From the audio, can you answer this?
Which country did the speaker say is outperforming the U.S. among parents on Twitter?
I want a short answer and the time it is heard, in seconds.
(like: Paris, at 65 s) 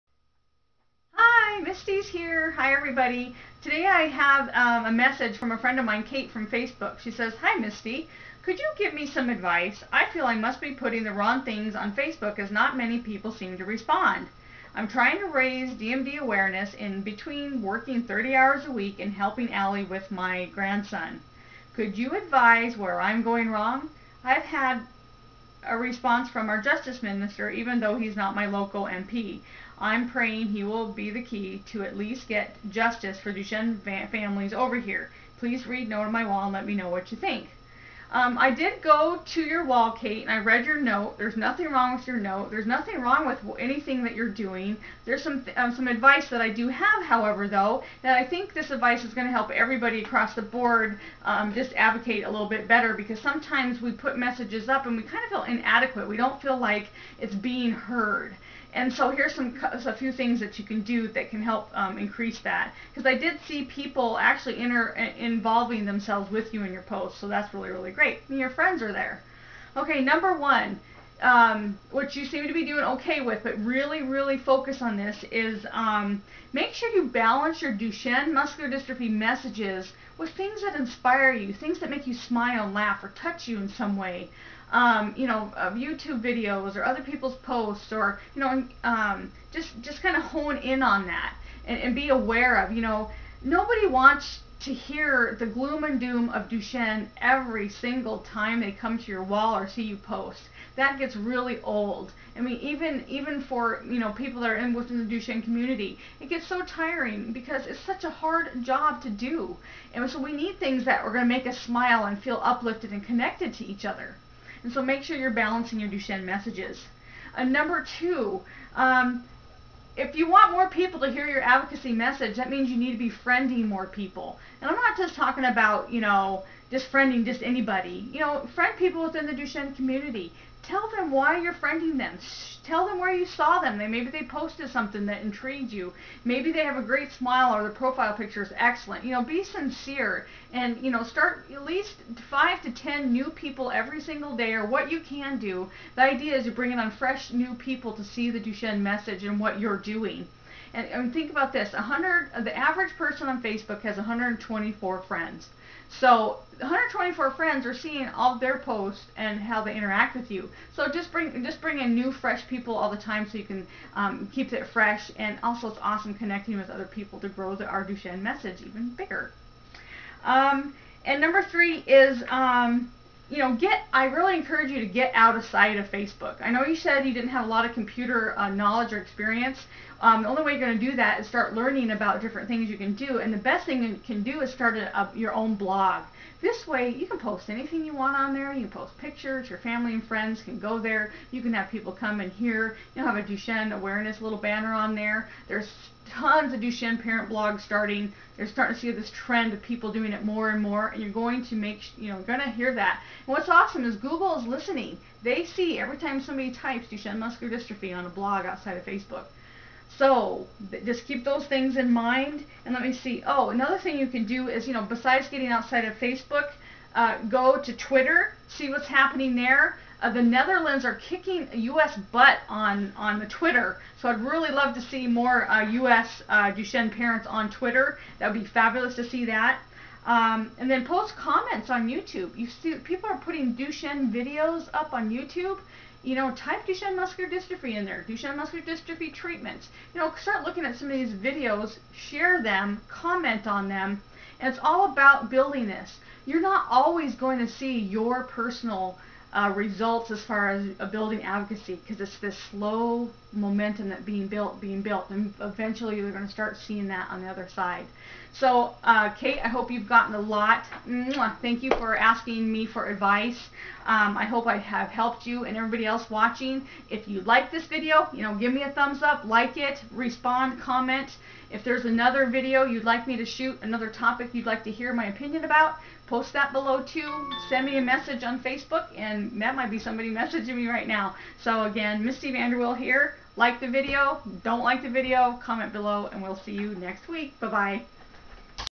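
The Netherlands, at 220 s.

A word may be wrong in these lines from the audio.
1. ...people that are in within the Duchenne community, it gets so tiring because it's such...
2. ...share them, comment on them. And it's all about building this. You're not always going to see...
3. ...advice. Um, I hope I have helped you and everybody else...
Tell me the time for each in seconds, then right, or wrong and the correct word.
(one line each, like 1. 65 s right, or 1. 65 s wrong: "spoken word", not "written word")
1. 104 s right
2. 241 s right
3. 262 s right.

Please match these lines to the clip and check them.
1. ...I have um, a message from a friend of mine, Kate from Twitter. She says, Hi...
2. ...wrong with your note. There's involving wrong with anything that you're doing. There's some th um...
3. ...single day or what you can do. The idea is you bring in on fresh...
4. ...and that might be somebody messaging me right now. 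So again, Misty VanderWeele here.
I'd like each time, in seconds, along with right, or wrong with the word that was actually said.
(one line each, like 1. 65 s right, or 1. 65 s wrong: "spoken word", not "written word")
1. 3 s wrong: "Facebook", not "Twitter"
2. 41 s wrong: "nothing", not "involving"
3. 144 s right
4. 278 s right.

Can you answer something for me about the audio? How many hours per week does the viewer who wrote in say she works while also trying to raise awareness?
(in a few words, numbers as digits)
30.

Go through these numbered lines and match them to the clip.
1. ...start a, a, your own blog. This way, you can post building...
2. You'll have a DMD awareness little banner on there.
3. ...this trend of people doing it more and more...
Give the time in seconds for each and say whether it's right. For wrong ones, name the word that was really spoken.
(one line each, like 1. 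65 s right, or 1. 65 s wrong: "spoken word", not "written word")
1. 184 s wrong: "anything", not "building"
2. 192 s wrong: "Duchenne", not "DMD"
3. 198 s right.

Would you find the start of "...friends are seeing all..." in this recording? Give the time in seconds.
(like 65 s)
157 s.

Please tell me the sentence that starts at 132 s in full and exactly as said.
Tell them where you saw them.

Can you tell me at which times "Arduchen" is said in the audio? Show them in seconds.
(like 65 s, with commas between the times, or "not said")
167 s.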